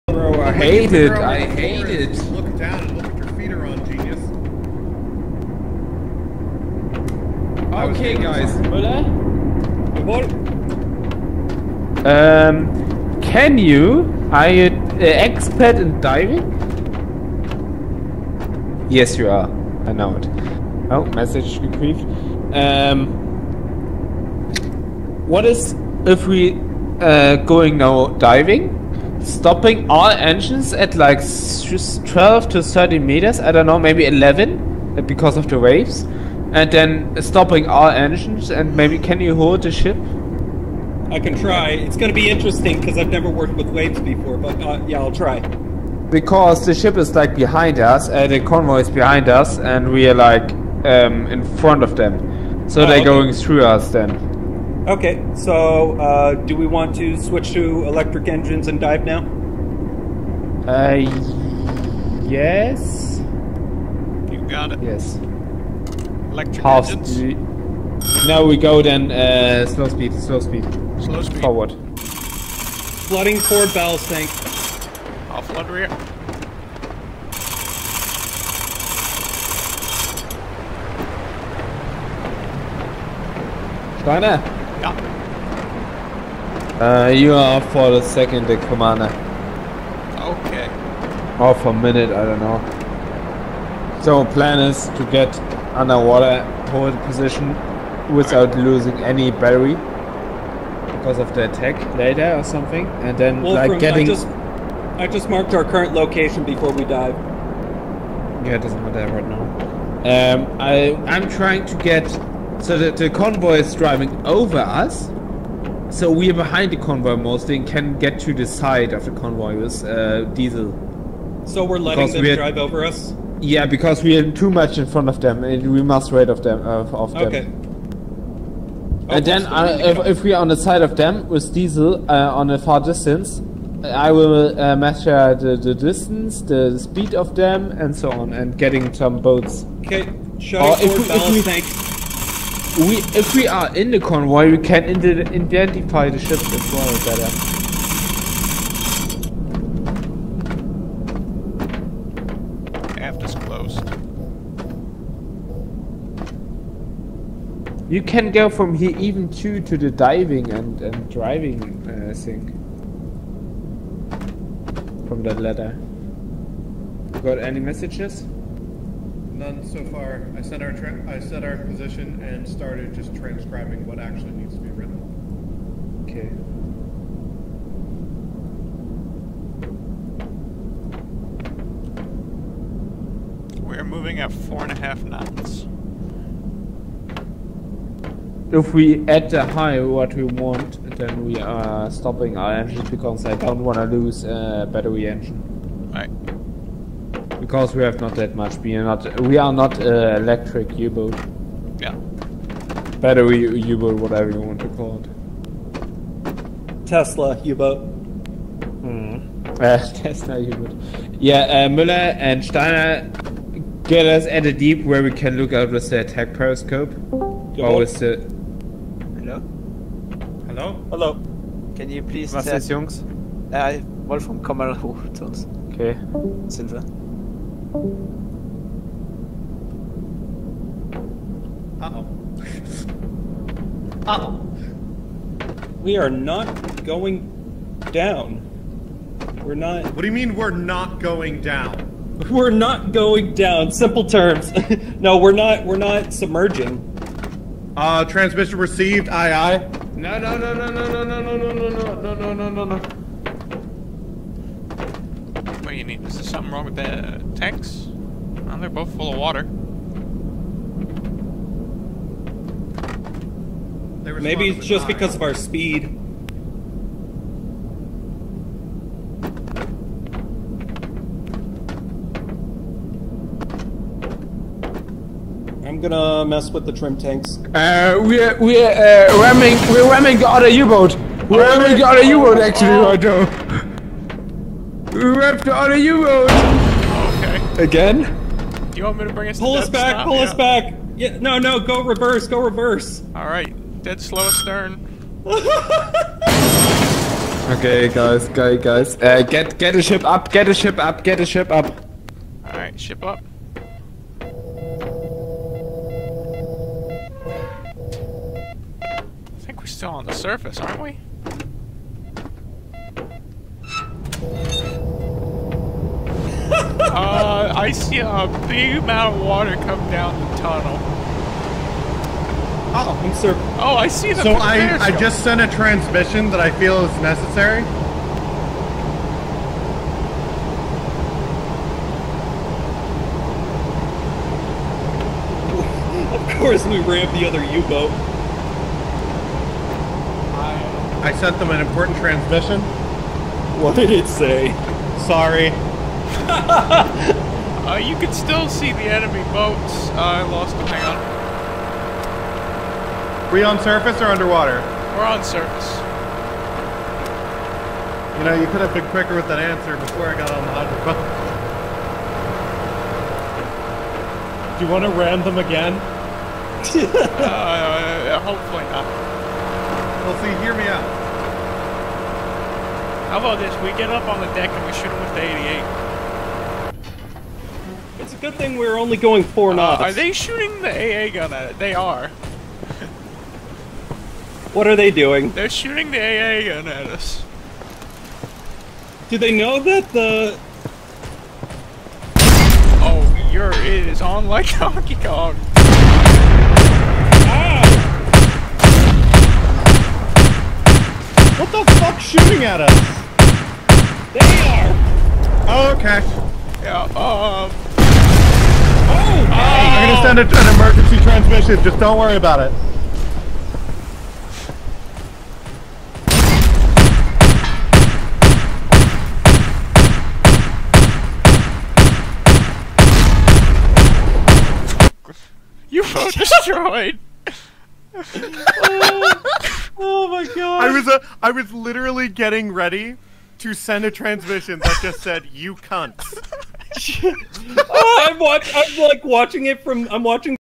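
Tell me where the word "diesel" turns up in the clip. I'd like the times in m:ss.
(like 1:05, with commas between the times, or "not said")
2:00, 2:11.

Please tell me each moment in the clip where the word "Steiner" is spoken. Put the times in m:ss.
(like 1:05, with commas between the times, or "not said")
1:23, 3:32.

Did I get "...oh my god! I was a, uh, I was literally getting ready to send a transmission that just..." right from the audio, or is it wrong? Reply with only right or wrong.
right.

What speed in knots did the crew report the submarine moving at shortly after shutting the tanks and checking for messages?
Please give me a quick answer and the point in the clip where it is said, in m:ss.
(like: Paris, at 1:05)
4.5, at 3:04.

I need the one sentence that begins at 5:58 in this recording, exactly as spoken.
You know, you could have been quicker with that answer before I got on the hydrophone.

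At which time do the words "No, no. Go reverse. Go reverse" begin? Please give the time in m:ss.
4:51.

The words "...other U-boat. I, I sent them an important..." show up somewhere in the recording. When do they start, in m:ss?
5:37.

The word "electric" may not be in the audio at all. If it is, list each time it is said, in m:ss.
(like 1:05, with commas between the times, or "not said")
0:57, 1:06, 3:20.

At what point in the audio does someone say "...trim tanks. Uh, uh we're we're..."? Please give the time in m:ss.
4:36.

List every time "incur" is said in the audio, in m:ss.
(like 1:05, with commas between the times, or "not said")
not said.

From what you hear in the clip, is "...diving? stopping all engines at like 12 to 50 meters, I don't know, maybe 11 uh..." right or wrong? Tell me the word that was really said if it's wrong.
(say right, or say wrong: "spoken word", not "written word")
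wrong: "30", not "50".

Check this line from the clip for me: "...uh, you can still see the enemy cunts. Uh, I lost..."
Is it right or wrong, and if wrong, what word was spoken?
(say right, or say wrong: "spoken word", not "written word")
wrong: "boats", not "cunts".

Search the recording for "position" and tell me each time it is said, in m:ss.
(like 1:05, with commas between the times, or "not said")
1:37, 2:51.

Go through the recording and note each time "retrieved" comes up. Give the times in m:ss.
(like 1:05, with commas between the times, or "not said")
0:21.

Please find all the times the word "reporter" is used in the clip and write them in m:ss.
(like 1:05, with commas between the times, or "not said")
not said.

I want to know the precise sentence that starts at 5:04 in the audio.
I think we're still on the surface, aren't we?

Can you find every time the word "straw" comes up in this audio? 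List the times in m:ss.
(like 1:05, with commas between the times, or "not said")
not said.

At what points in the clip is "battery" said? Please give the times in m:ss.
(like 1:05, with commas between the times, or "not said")
1:39, 3:14, 3:23.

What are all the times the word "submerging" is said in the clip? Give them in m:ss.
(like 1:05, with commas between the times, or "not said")
4:06.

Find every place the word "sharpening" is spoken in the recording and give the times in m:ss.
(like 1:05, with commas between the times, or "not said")
not said.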